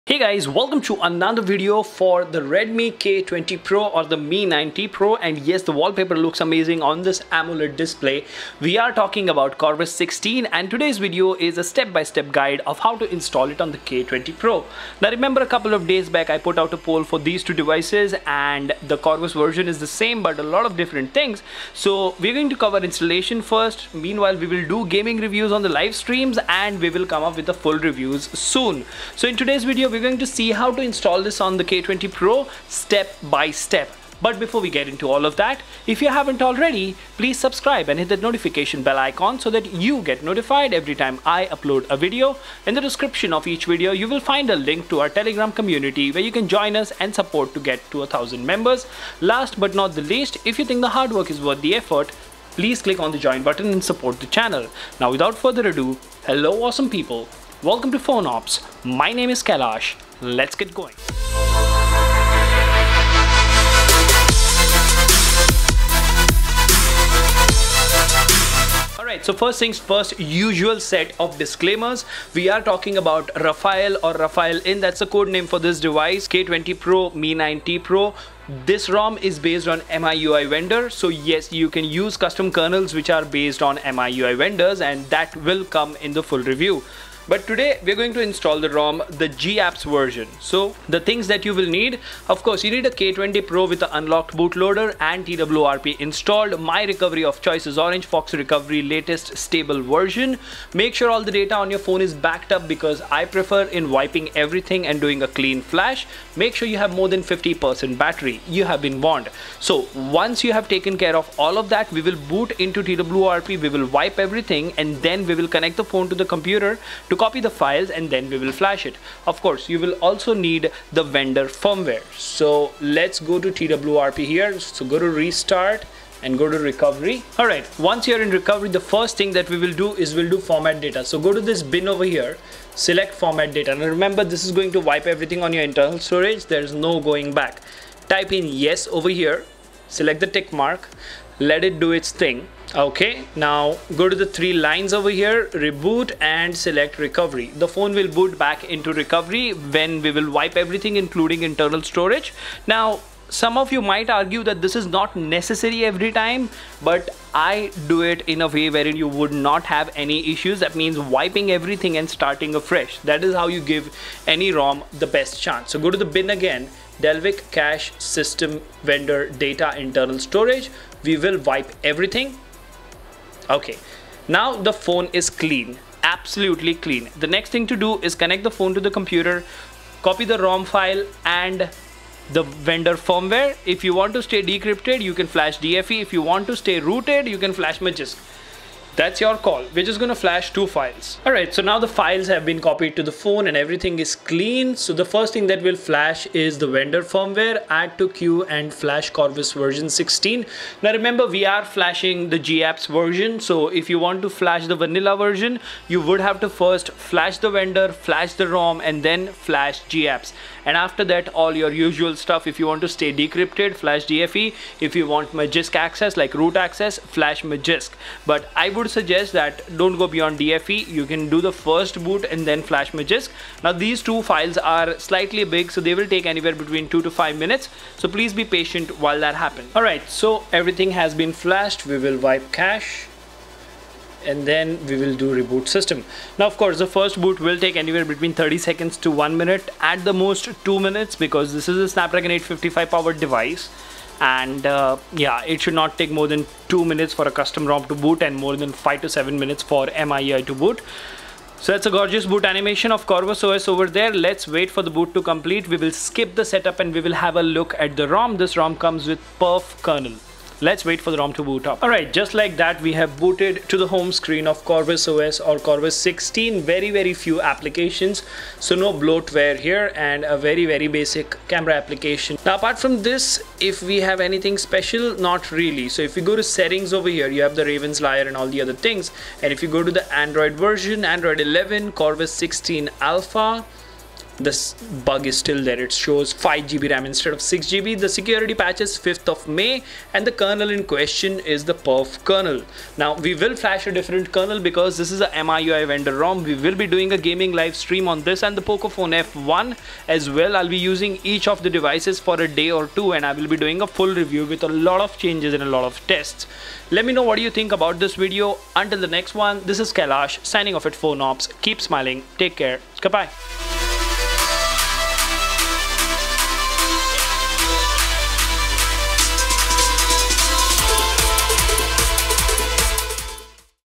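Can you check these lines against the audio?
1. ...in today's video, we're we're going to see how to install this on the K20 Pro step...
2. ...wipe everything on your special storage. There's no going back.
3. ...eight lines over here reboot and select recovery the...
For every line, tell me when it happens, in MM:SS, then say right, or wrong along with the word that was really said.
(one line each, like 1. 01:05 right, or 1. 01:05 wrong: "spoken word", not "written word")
1. 00:29 right
2. 02:14 wrong: "internal", not "special"
3. 02:24 wrong: "three", not "eight".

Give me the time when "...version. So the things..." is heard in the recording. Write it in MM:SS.
01:29.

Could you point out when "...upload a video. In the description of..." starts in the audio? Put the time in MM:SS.
00:41.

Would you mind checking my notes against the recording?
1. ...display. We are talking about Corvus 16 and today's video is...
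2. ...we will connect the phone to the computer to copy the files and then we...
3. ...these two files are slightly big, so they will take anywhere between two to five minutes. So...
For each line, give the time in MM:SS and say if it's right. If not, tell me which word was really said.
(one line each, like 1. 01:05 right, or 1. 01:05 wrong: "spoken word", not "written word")
1. 00:07 right
2. 01:55 right
3. 03:43 right.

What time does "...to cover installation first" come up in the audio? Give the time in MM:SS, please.
00:22.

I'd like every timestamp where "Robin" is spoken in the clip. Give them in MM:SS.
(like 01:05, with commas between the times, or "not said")
not said.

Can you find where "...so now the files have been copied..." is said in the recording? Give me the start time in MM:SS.
03:11.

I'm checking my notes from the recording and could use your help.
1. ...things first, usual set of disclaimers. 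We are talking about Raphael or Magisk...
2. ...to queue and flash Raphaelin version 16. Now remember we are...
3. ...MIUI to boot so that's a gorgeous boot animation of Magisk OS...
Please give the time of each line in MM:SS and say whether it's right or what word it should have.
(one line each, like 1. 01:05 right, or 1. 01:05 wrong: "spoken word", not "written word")
1. 01:09 wrong: "Raphaelin", not "Magisk"
2. 03:17 wrong: "Corvus", not "Raphaelin"
3. 04:09 wrong: "Corvus", not "Magisk".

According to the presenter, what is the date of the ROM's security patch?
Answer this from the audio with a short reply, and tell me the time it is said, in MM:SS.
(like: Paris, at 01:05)
5th of May, at 04:48.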